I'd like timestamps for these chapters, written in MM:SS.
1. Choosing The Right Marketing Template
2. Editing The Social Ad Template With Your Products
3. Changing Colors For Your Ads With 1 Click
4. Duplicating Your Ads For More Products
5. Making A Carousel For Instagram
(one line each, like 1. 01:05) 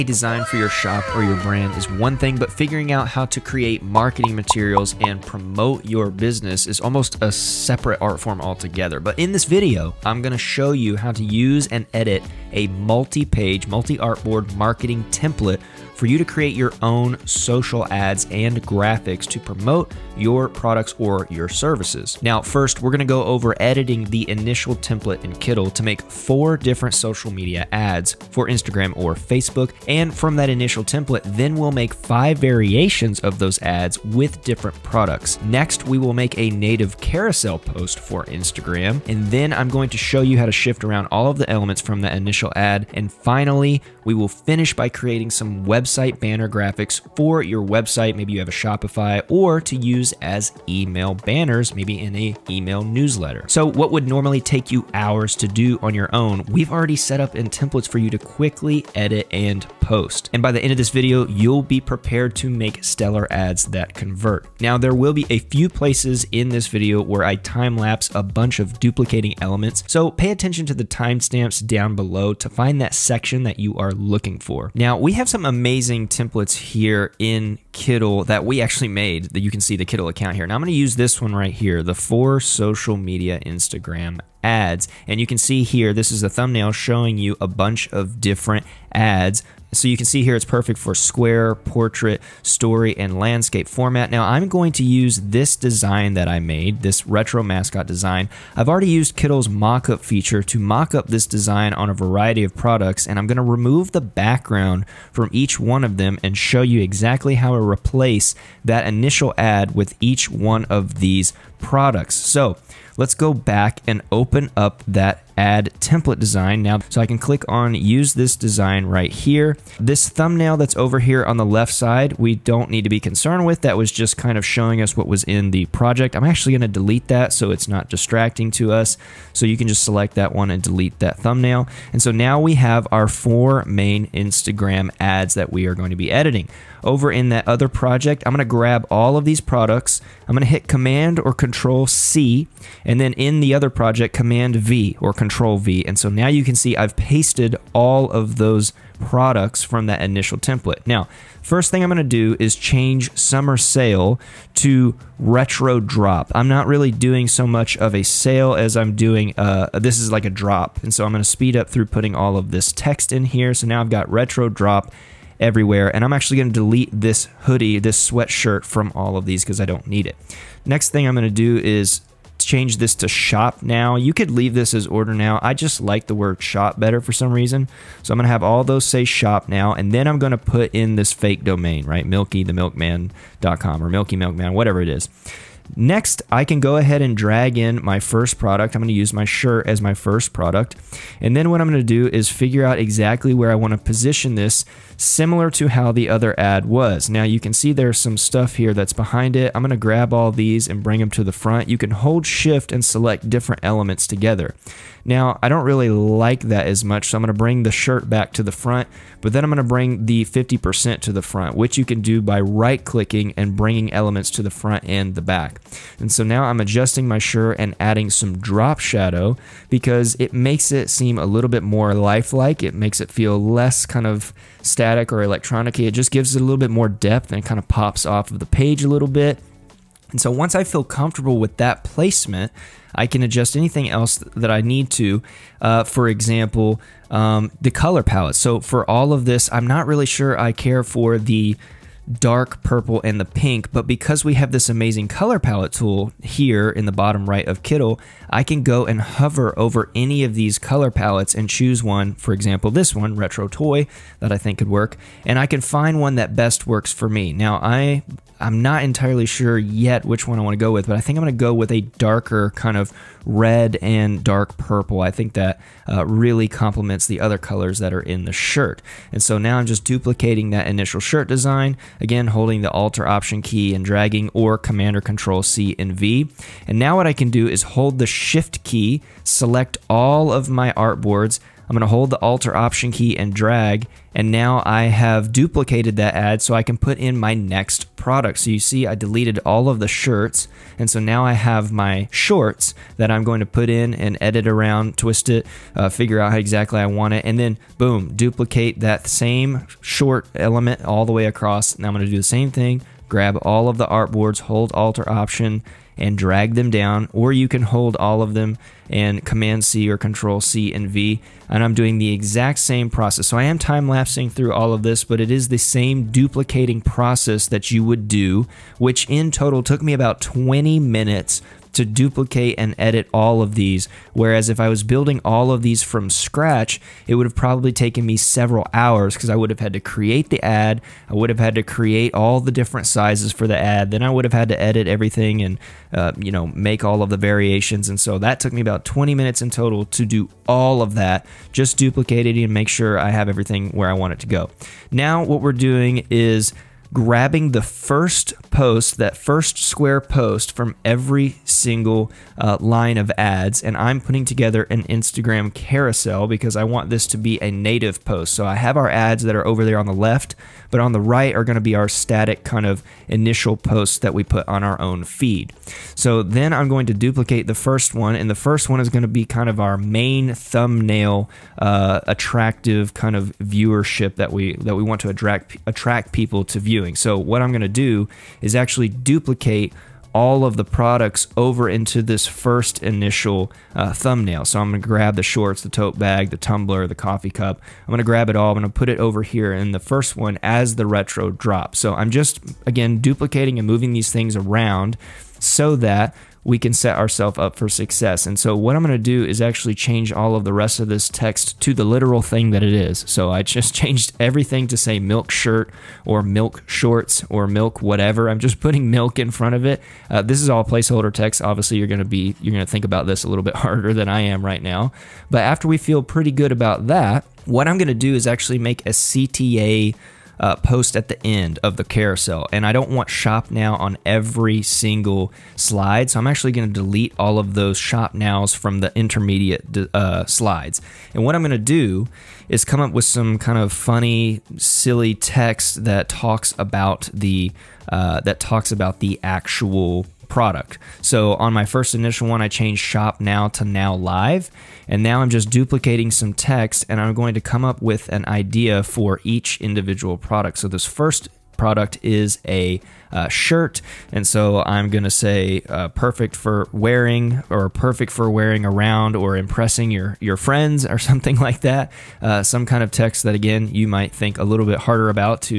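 1. 01:14
2. 01:59
3. 03:44
4. 04:29
5. 05:44.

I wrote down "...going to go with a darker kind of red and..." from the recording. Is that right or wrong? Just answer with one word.
right.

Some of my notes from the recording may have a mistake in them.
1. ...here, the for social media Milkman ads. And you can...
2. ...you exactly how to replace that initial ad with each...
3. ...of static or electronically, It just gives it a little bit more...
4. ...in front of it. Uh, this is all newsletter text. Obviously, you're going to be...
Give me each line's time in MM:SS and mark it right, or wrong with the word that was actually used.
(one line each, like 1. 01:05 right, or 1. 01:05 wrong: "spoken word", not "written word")
1. 01:21 wrong: "Instagram", not "Milkman"
2. 01:46 right
3. 03:44 right
4. 06:49 wrong: "placeholder", not "newsletter".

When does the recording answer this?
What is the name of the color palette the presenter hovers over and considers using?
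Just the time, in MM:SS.
04:13.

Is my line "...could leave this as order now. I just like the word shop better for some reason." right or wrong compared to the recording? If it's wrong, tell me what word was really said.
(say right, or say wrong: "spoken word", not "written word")
right.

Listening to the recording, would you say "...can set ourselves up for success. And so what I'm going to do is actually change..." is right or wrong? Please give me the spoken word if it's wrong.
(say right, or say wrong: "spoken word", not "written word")
right.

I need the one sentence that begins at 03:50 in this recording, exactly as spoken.
And so once I feel comfortable with that placement, I can adjust anything else that I need to.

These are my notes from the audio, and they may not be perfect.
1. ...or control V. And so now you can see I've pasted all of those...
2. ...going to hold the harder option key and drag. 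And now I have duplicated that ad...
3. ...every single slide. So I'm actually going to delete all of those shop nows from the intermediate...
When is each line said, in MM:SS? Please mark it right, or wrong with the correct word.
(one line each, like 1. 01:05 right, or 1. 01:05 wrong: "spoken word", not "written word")
1. 02:24 right
2. 04:41 wrong: "alter", not "harder"
3. 07:04 right.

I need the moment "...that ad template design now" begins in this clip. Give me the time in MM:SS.
01:54.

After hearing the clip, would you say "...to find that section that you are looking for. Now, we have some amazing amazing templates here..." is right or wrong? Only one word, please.
right.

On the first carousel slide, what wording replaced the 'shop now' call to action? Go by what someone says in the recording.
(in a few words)
Now live.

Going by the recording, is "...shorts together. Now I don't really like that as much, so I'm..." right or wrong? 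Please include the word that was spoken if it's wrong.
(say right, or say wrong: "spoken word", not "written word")
wrong: "elements", not "shorts".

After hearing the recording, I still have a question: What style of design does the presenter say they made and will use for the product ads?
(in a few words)
Retro mascot.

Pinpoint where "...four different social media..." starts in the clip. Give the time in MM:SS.
00:26.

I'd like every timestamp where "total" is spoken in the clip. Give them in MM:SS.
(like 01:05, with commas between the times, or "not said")
05:19, 05:39.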